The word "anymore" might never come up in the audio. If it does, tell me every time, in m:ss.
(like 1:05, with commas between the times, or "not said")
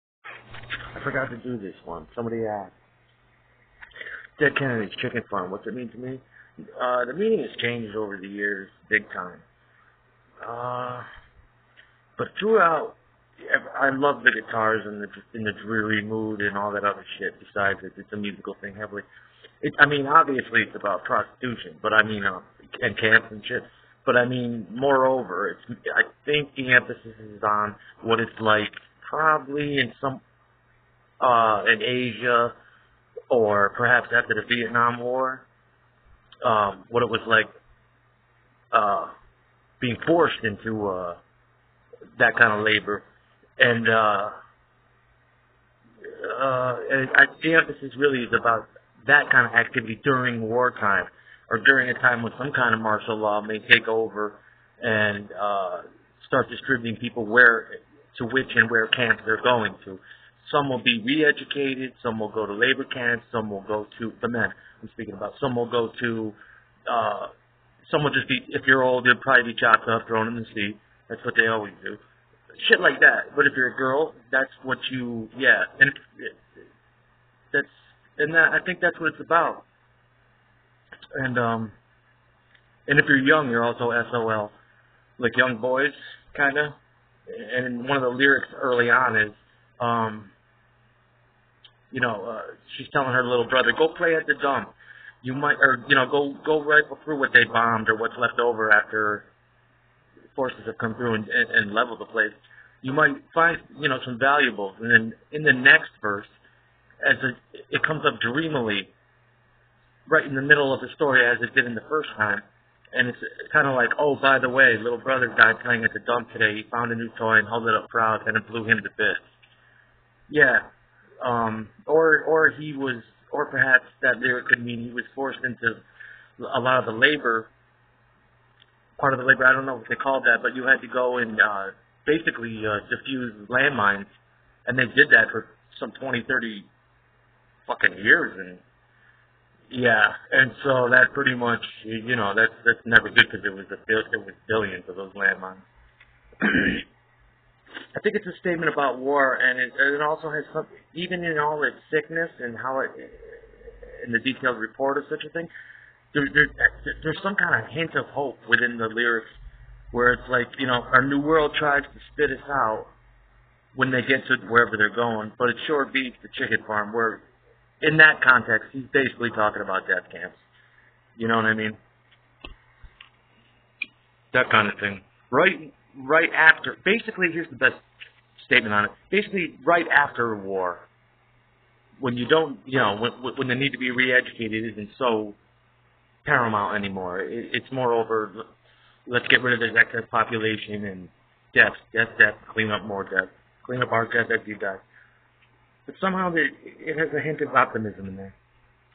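3:06.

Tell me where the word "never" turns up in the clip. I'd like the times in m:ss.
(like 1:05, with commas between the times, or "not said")
2:22.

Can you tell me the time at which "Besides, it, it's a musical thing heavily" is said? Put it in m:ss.
0:17.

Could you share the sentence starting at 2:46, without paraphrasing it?
Where, in that context, he's basically talking about death camps.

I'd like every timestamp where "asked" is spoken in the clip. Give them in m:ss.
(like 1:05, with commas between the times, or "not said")
0:02.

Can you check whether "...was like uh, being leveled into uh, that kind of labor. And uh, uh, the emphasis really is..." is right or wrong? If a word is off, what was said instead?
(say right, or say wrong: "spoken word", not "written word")
wrong: "forced", not "leveled".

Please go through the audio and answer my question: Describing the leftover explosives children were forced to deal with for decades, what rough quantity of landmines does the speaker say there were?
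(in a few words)
billions.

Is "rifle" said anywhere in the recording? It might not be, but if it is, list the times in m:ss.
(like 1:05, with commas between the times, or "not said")
1:36.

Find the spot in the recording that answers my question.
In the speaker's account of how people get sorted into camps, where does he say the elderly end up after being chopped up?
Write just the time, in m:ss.
1:10.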